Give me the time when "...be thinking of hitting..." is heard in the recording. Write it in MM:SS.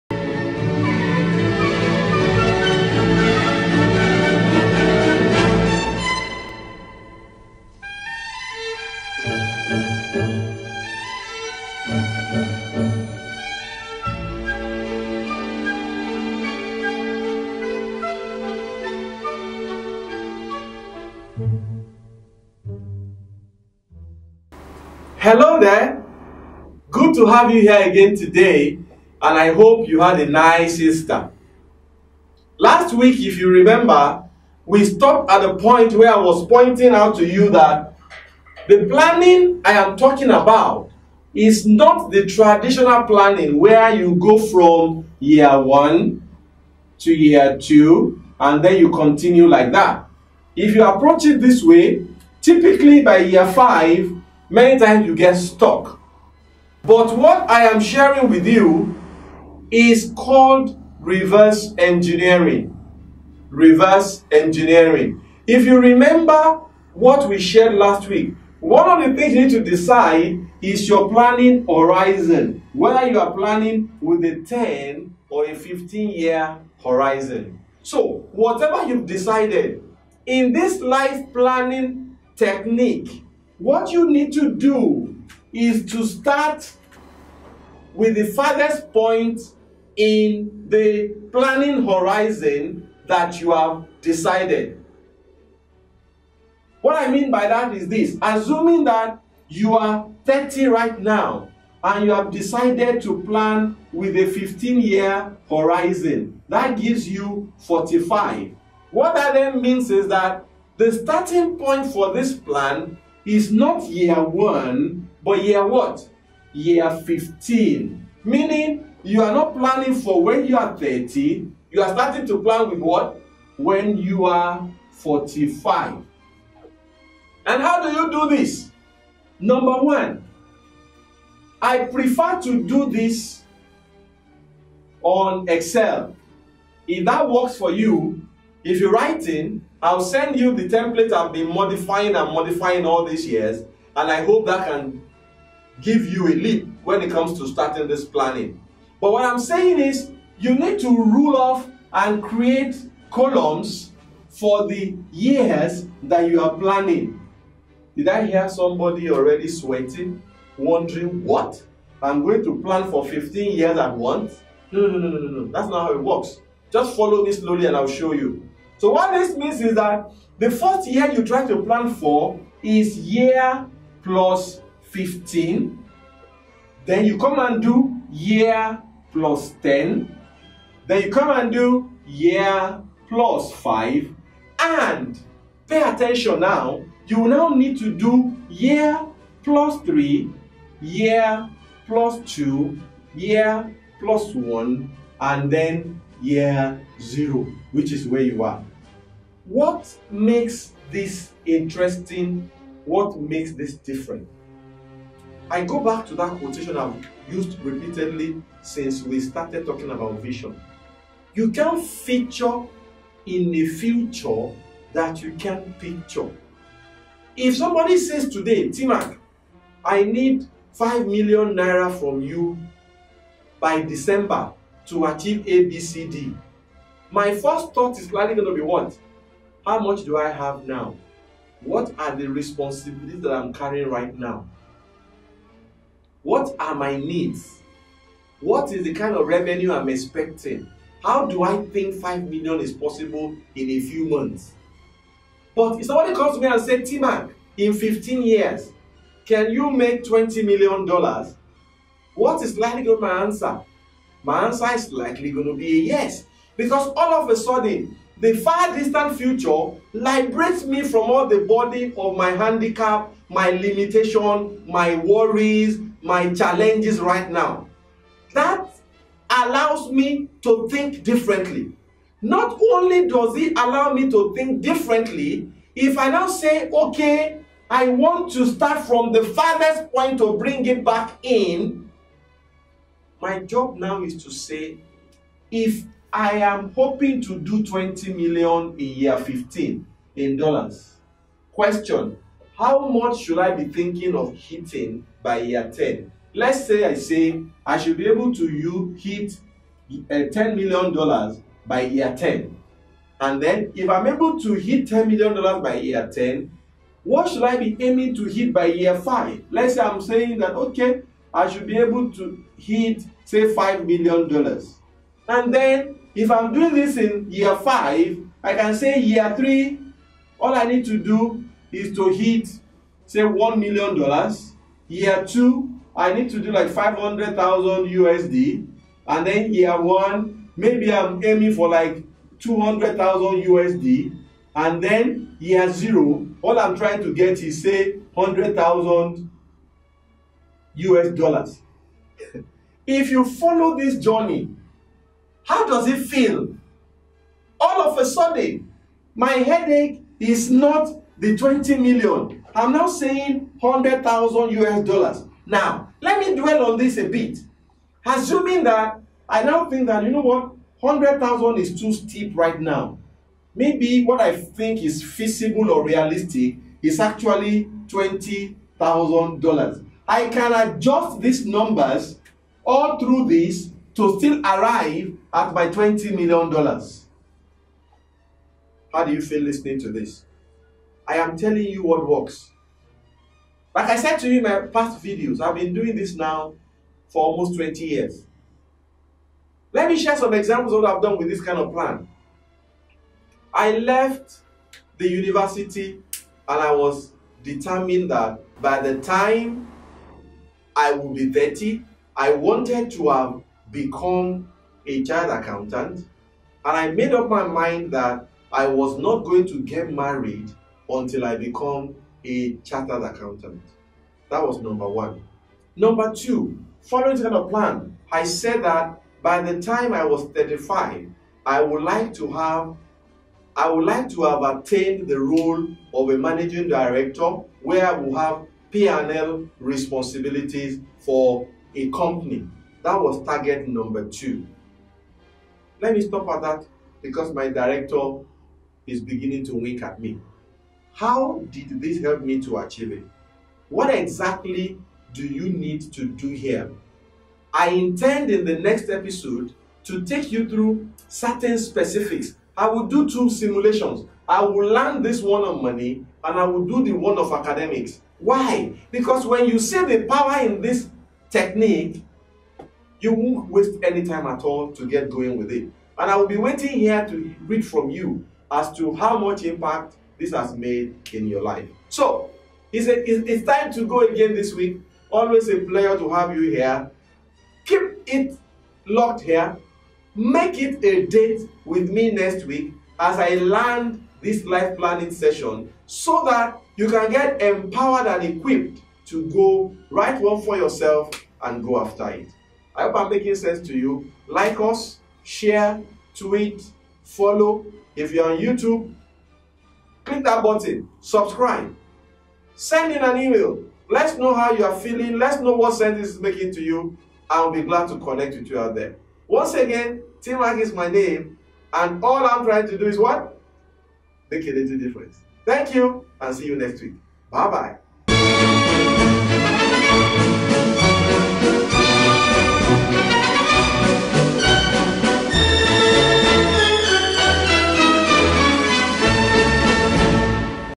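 04:53.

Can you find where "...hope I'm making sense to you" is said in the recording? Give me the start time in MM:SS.
08:12.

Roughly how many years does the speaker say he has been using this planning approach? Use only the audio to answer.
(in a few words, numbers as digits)
almost 20 years.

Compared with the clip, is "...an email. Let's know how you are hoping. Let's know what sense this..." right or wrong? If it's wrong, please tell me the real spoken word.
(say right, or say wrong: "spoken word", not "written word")
wrong: "feeling", not "hoping".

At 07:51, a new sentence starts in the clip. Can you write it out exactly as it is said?
So, it's, a, it's, it's time to go again this week.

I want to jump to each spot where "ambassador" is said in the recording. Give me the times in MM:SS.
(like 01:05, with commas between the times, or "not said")
not said.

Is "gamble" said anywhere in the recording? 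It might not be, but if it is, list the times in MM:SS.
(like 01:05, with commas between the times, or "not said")
not said.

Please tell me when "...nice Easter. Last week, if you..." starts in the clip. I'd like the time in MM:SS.
00:30.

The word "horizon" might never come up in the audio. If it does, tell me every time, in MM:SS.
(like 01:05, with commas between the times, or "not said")
01:11, 01:16, 01:31, 01:45.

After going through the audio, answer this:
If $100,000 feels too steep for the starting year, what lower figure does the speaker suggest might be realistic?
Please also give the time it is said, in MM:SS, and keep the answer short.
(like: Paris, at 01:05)
$20,000, at 06:07.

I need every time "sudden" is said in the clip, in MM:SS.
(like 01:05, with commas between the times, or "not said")
04:17, 05:48.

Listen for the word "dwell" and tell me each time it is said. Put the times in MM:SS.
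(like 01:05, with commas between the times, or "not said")
05:56.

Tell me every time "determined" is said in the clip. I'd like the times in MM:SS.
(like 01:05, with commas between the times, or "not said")
06:37.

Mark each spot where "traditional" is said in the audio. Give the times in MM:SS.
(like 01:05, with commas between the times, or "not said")
00:42.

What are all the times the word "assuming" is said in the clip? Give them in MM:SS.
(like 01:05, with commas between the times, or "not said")
01:38, 05:58.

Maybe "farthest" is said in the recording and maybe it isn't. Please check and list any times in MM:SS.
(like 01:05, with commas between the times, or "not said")
01:28, 04:39.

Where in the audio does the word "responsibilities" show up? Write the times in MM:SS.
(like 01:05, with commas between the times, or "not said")
03:52, 07:09.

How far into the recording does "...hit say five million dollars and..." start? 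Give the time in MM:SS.
05:12.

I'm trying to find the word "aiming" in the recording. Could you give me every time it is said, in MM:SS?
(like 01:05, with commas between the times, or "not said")
05:07, 05:31.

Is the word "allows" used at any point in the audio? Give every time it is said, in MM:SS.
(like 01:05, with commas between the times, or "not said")
04:29, 04:33.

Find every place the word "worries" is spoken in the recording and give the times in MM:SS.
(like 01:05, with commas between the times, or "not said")
04:24.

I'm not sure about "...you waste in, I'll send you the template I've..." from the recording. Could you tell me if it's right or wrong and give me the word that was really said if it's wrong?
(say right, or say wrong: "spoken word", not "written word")
wrong: "write", not "waste".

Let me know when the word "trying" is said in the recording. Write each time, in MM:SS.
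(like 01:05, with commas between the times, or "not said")
05:36, 08:32.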